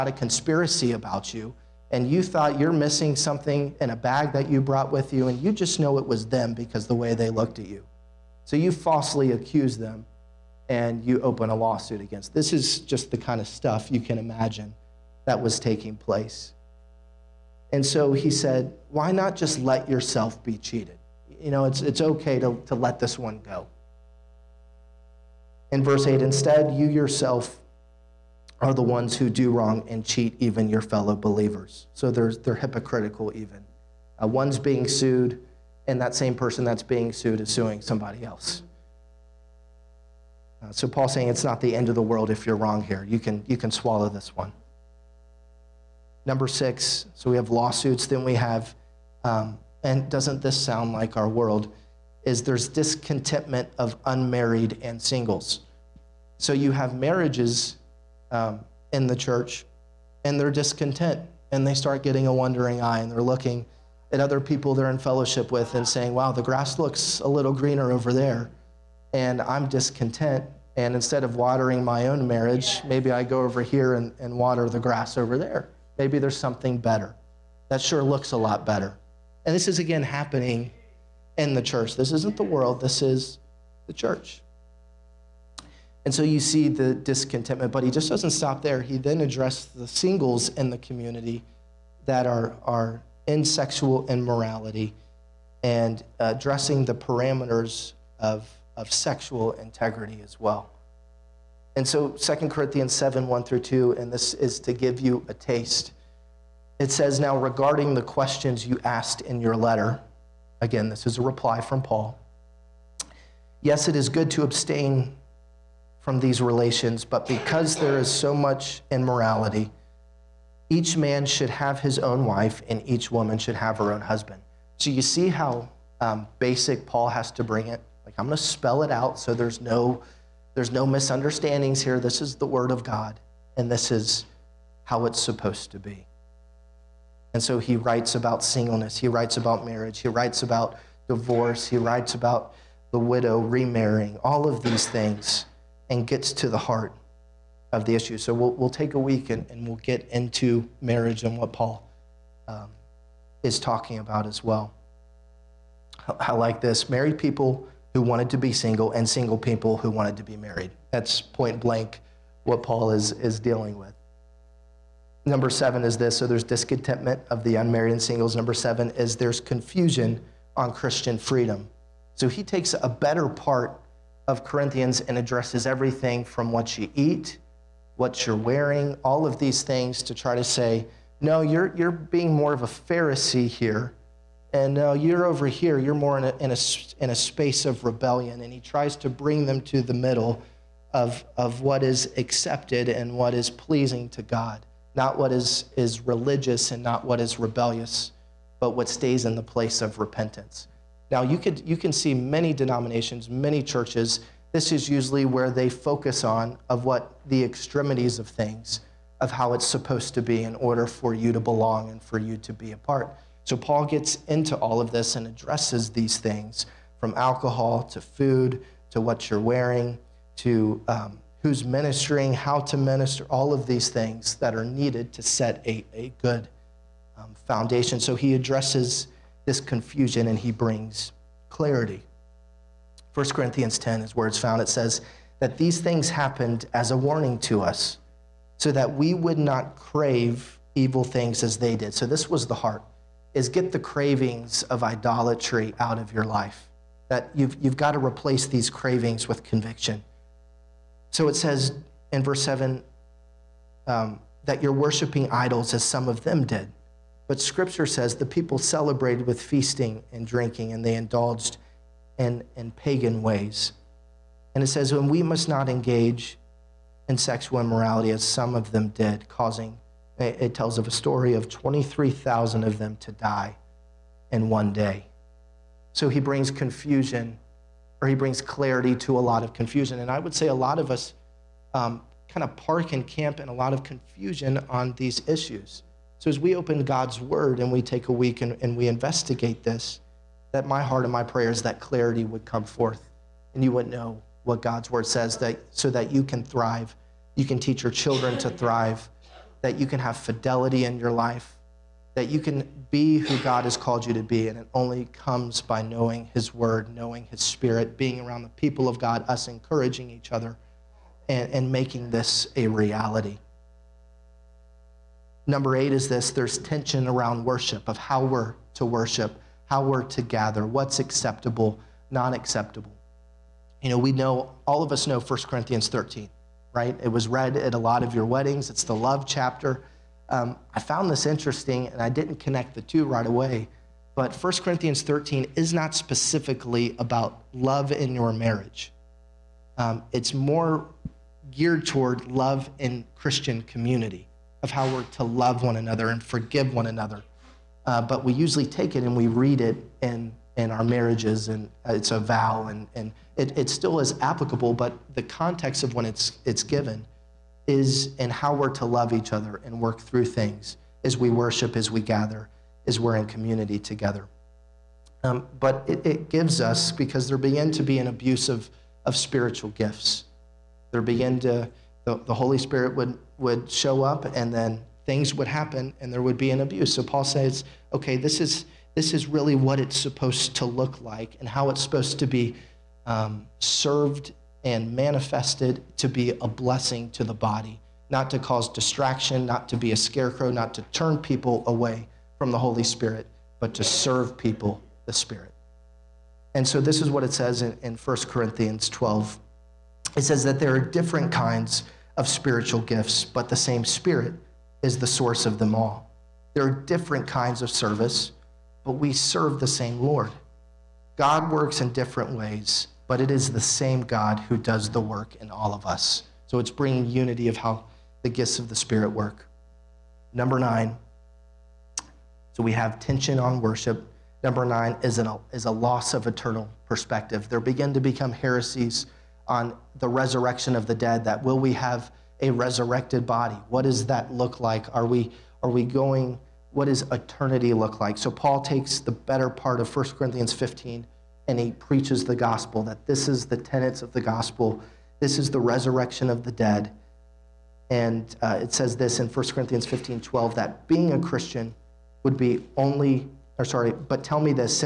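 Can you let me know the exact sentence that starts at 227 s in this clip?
So he addresses this confusion and he brings clarity.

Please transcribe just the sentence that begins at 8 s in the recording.
So you falsely accuse them and you open a lawsuit against.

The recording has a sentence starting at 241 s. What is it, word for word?
So this was the heart is get the cravings of idolatry out of your life.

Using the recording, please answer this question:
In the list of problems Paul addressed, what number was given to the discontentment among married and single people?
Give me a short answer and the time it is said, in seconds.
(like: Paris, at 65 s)
6, at 46 s.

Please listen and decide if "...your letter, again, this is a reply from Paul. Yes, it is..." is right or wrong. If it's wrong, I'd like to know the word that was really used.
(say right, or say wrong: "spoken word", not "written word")
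right.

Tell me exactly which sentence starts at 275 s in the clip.
So he brings confusion, or he brings clarity to a lot of confusion.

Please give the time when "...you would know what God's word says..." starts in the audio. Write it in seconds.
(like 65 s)
293 s.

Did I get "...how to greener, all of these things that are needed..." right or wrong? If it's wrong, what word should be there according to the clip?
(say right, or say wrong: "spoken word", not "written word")
wrong: "minister", not "greener".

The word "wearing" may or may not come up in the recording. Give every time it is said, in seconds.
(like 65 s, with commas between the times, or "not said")
178 s, 219 s.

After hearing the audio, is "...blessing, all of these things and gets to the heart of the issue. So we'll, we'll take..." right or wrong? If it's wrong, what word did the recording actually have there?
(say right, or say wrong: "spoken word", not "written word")
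wrong: "remarrying", not "blessing".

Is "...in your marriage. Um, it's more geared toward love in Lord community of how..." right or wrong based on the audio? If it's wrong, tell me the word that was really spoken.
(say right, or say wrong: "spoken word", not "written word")
wrong: "Christian", not "Lord".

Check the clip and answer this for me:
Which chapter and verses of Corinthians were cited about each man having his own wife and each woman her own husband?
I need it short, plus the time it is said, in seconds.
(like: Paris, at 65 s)
7:1-2, at 102 s.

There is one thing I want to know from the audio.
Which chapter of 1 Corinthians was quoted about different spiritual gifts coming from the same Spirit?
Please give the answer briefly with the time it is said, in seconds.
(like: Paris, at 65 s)
1 Corinthians 12, at 397 s.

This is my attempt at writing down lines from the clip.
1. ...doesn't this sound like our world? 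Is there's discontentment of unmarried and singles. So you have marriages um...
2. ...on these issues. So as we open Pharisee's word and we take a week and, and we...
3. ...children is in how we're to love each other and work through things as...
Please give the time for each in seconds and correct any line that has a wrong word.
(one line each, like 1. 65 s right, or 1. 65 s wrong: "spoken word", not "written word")
1. 50 s right
2. 284 s wrong: "God", not "Pharisee"
3. 356 s wrong: "given", not "children".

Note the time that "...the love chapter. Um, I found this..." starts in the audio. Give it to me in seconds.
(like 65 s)
328 s.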